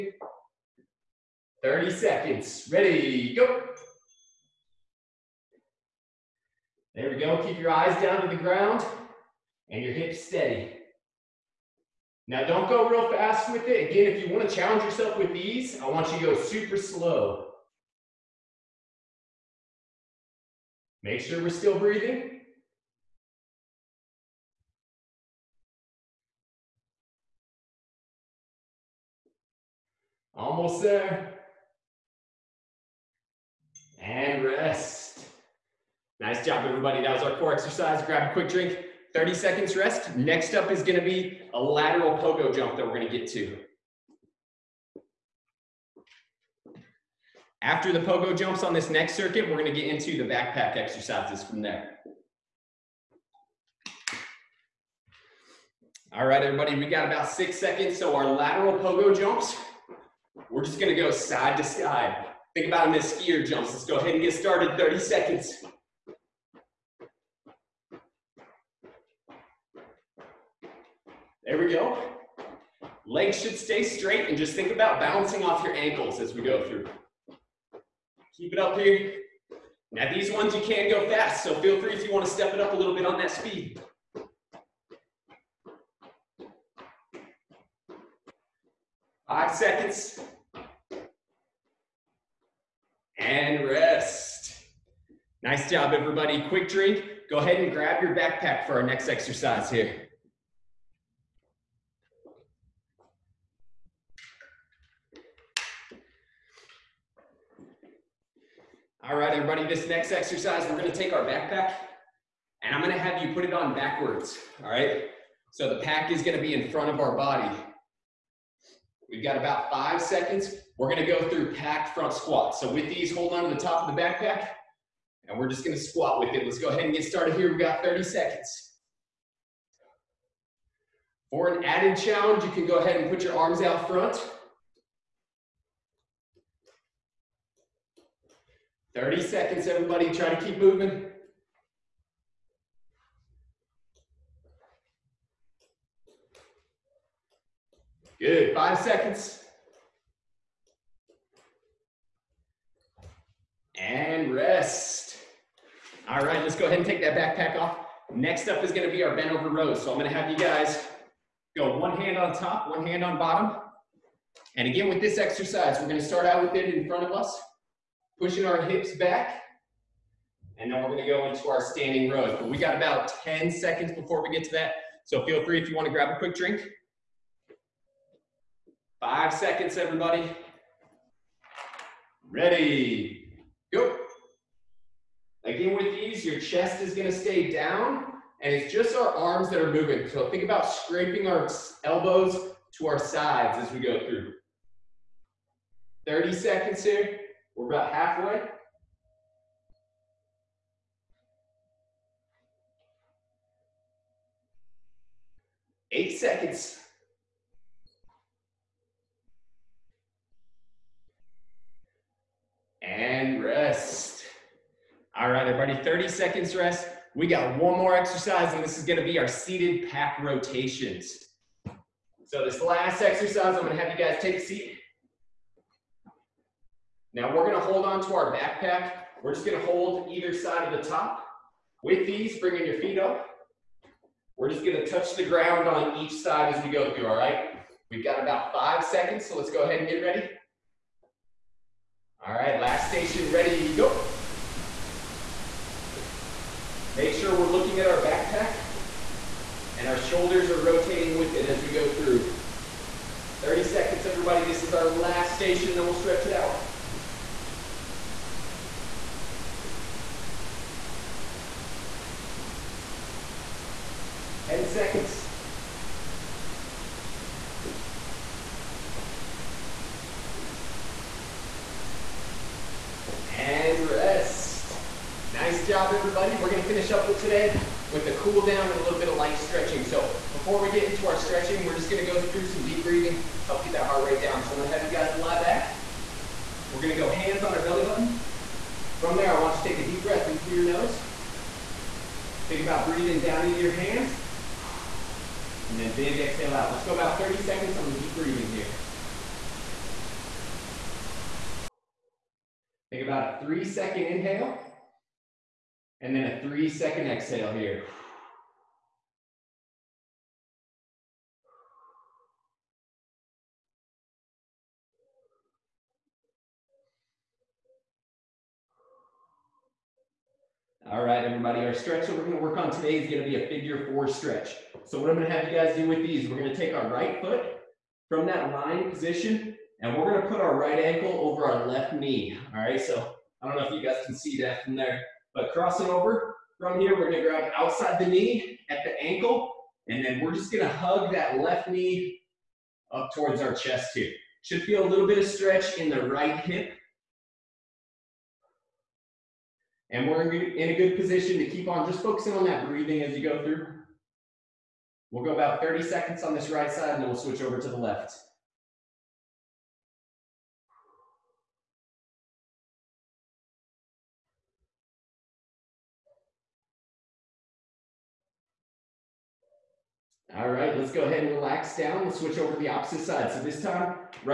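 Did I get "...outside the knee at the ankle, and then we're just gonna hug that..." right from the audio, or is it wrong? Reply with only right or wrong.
right.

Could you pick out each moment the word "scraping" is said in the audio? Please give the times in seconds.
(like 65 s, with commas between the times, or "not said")
190 s.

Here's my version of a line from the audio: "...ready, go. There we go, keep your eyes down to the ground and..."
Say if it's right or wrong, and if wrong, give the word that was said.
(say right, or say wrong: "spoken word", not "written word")
right.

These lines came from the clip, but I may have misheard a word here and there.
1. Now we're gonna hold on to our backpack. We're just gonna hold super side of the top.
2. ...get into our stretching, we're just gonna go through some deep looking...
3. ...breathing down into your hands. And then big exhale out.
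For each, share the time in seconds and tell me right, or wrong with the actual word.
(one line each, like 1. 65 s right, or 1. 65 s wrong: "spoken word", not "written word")
1. 227 s wrong: "either", not "super"
2. 280 s wrong: "breathing", not "looking"
3. 292 s right.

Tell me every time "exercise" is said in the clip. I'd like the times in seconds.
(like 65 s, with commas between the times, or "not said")
37 s, 50 s, 99 s, 110 s, 165 s, 217 s, 223 s.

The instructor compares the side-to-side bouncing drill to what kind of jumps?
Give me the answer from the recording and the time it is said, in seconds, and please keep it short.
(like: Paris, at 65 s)
skier jumps, at 63 s.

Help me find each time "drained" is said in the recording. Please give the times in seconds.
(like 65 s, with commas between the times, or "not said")
not said.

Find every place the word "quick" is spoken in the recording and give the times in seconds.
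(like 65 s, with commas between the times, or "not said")
38 s, 96 s, 176 s.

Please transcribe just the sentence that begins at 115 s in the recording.
So the pack is gonna be in front of our body.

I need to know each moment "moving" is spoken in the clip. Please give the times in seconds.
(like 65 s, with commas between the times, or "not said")
140 s, 189 s.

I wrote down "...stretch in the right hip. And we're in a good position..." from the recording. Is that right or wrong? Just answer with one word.
right.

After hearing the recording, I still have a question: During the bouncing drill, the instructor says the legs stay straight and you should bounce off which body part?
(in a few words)
ankles.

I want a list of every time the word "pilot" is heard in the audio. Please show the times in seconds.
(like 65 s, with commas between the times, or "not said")
not said.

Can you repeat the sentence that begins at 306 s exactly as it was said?
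And then a three second exhale here.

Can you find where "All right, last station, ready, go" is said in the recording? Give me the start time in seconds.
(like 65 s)
242 s.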